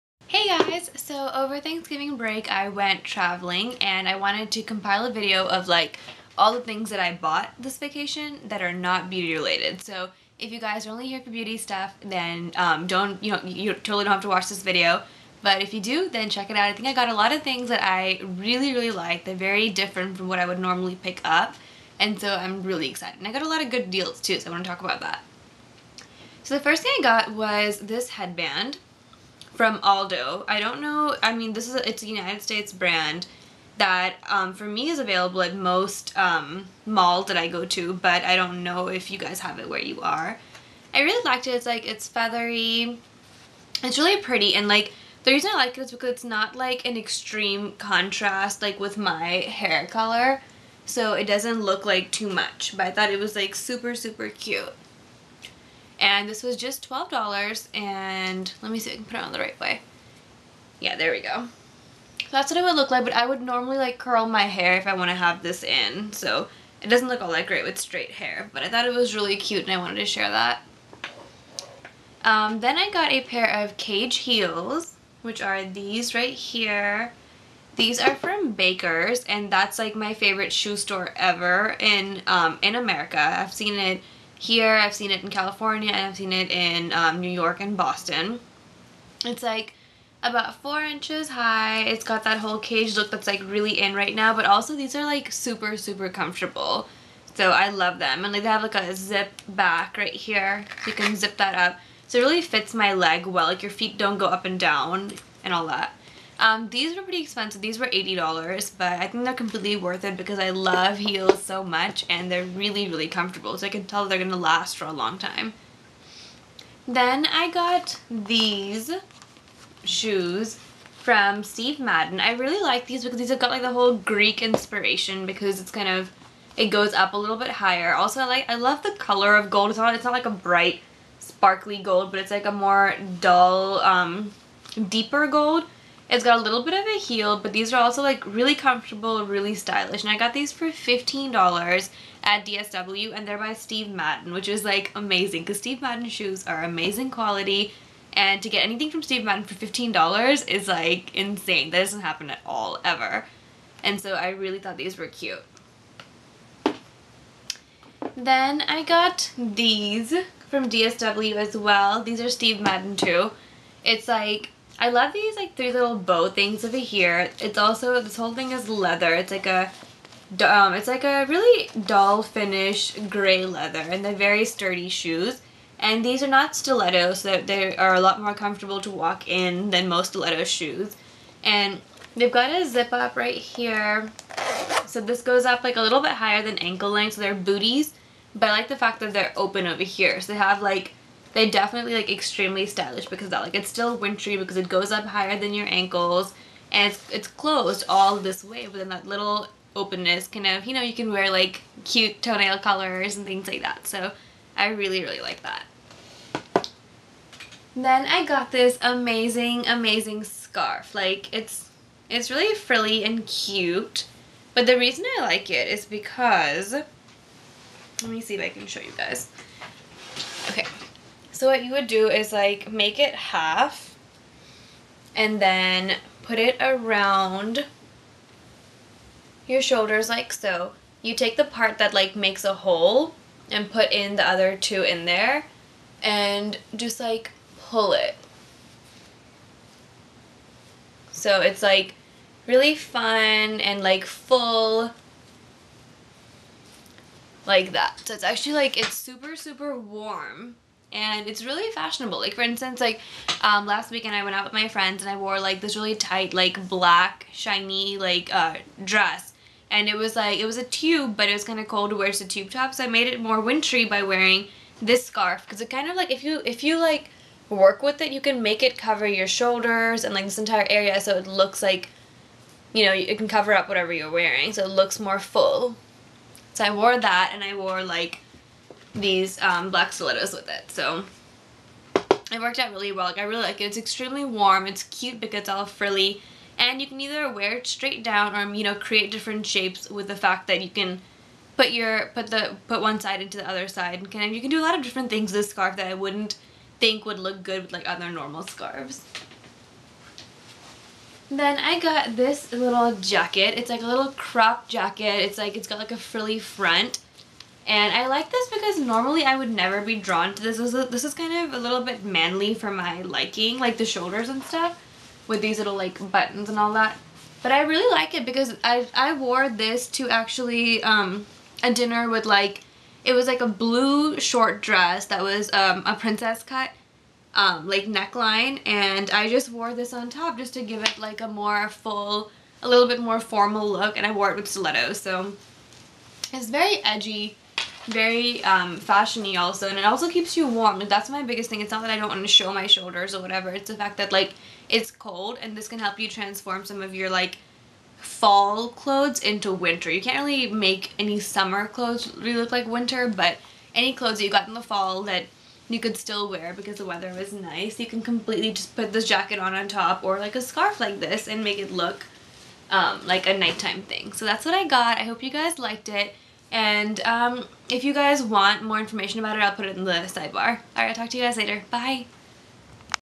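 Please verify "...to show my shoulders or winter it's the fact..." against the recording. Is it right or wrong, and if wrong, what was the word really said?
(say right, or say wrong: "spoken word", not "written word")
wrong: "whatever", not "winter".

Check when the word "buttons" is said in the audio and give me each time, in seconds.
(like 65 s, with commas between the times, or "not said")
316 s.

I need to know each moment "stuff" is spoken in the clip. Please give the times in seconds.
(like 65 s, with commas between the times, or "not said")
11 s, 314 s.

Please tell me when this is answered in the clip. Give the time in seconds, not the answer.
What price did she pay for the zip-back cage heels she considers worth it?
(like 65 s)
107 s.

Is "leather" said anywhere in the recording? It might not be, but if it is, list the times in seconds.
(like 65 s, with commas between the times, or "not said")
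168 s, 173 s.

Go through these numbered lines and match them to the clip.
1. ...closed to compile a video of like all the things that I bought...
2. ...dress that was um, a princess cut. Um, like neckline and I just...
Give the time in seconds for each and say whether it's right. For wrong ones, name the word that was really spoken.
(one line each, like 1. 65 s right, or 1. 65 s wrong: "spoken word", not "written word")
1. 4 s wrong: "wanted", not "closed"
2. 324 s right.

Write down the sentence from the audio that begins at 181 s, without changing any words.
And they've got a zip up right here.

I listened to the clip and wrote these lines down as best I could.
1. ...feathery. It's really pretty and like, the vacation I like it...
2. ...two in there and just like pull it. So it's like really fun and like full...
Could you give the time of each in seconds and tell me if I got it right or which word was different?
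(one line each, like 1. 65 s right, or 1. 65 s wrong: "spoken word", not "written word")
1. 42 s wrong: "reason", not "vacation"
2. 234 s right.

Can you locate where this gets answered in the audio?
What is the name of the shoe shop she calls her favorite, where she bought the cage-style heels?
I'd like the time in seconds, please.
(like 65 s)
78 s.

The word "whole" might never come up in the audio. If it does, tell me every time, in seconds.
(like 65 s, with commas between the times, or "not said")
92 s, 123 s, 168 s.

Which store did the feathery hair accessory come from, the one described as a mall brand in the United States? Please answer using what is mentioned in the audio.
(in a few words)
Aldo.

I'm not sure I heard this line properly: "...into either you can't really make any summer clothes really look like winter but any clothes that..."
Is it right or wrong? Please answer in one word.
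wrong.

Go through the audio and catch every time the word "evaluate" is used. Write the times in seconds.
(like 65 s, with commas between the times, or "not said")
not said.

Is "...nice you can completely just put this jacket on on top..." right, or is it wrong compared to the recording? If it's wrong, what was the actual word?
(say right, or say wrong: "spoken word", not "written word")
right.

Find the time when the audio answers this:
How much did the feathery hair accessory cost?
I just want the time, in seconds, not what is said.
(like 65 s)
56 s.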